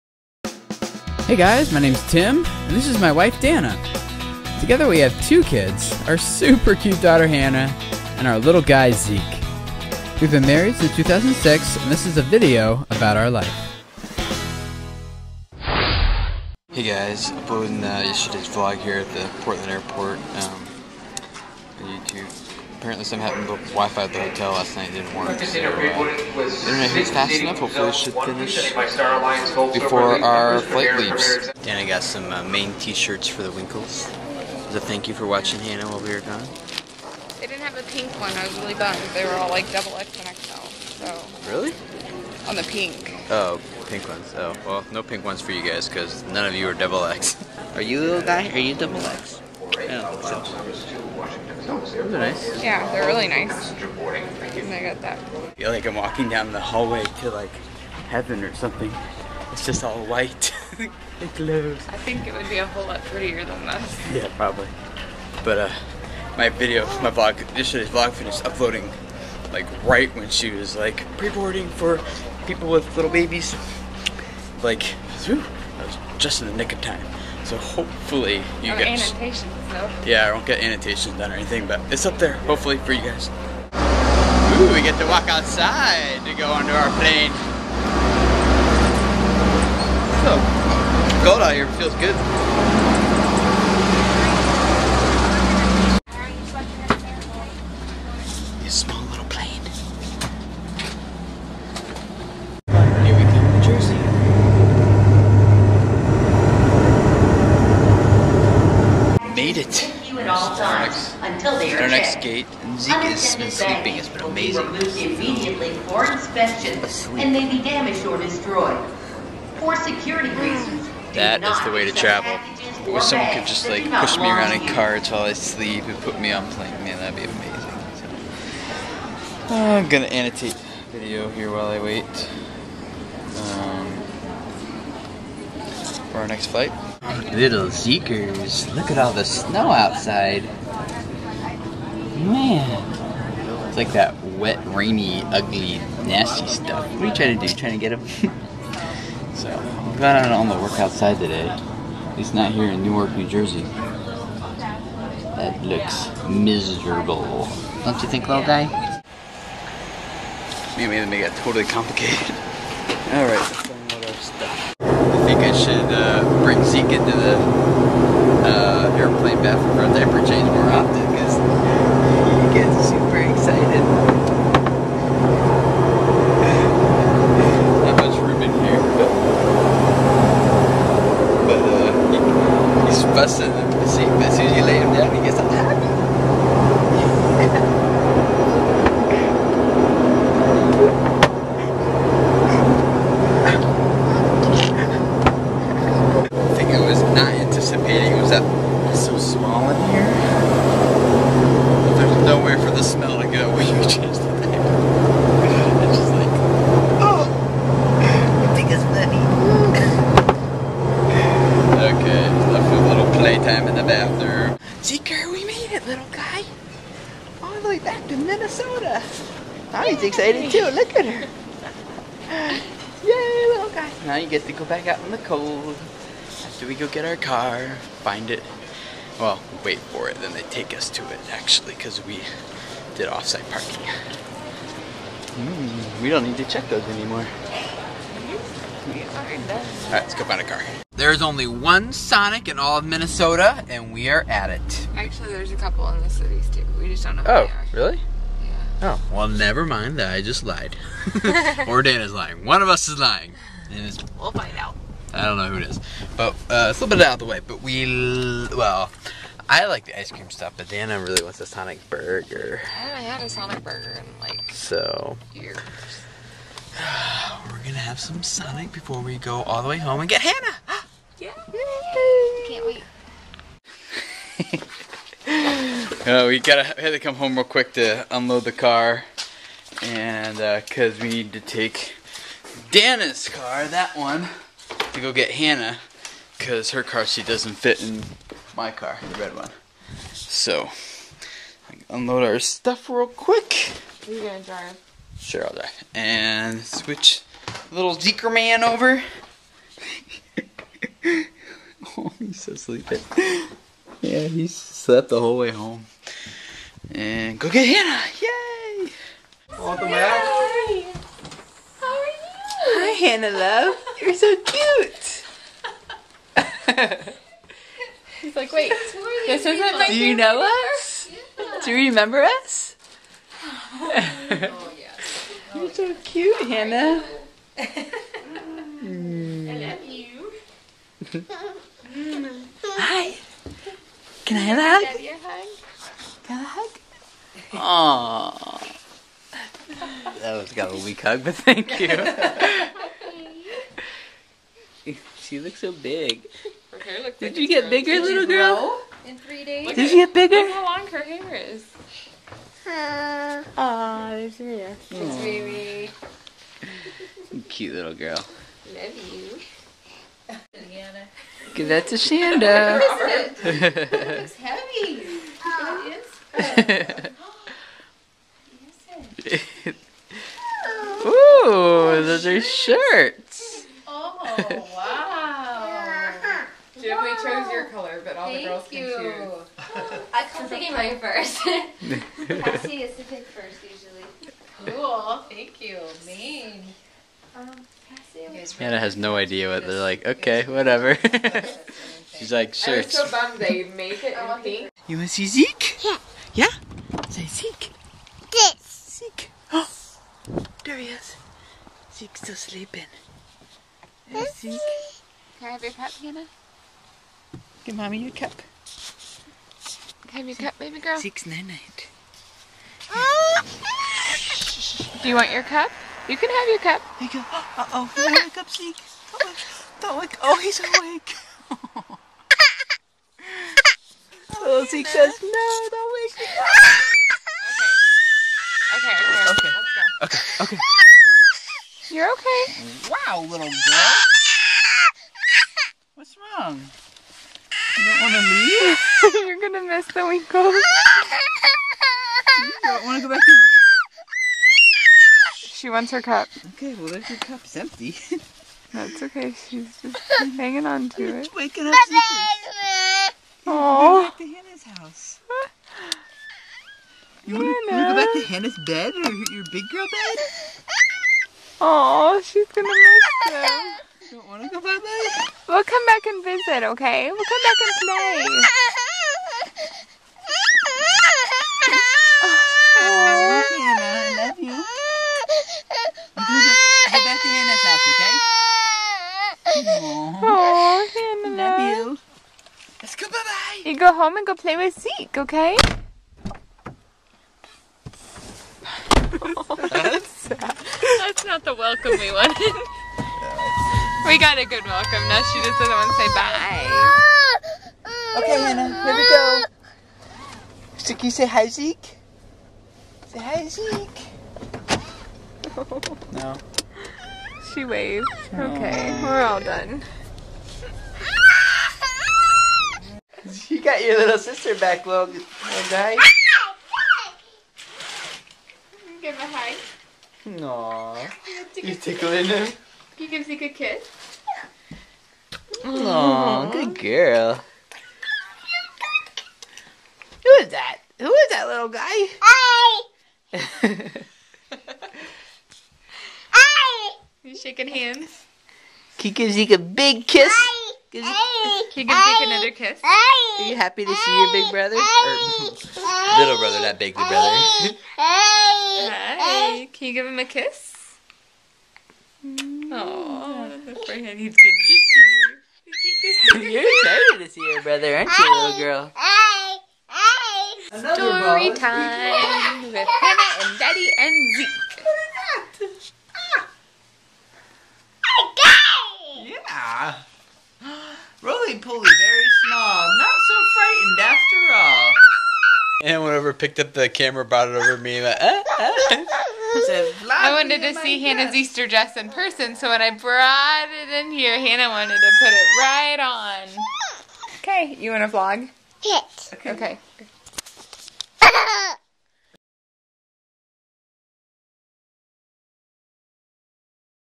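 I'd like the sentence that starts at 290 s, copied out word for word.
So, unload our stuff real quick.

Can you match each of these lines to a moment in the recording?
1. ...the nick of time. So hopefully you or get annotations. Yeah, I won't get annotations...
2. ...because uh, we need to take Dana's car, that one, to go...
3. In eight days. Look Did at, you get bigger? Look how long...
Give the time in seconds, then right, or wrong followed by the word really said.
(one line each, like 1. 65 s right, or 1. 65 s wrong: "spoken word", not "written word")
1. 76 s right
2. 280 s right
3. 349 s wrong: "three", not "eight".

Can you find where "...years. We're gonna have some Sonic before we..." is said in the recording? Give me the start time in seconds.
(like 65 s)
265 s.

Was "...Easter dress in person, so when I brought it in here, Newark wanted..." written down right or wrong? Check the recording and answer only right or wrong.
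wrong.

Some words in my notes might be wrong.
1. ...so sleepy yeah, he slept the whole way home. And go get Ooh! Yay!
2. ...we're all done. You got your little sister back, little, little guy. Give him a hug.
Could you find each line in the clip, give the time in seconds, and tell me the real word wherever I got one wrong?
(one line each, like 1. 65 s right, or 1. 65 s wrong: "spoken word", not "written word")
1. 302 s wrong: "Hannah", not "Ooh"
2. 509 s right.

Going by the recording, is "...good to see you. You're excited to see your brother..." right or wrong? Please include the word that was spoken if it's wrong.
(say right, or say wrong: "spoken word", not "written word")
right.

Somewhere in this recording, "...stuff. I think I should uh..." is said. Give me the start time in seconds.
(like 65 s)
164 s.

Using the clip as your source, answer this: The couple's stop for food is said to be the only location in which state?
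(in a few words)
Minnesota.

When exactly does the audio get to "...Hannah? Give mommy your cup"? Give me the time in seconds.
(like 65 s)
405 s.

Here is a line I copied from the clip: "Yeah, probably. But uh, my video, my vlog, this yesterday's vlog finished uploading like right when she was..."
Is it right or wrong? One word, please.
right.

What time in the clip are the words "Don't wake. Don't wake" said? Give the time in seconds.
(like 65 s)
419 s.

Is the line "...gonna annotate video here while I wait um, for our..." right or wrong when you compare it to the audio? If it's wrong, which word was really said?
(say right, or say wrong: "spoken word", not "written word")
right.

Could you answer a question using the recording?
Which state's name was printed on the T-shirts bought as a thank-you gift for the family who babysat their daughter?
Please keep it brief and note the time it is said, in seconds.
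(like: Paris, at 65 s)
Maine, at 32 s.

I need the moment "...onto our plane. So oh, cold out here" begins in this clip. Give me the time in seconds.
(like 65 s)
86 s.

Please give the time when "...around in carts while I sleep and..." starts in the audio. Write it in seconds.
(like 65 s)
124 s.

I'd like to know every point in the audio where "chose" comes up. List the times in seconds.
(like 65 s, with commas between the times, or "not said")
377 s.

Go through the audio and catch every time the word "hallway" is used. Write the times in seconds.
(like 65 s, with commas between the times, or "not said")
56 s.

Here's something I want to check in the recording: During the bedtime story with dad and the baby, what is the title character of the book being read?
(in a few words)
Roly Poly.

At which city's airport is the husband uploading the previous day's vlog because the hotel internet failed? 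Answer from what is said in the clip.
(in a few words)
Portland.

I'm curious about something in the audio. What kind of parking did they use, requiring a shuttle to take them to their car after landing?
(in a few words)
Off-site parking.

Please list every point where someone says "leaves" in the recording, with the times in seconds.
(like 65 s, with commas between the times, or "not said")
30 s, 438 s.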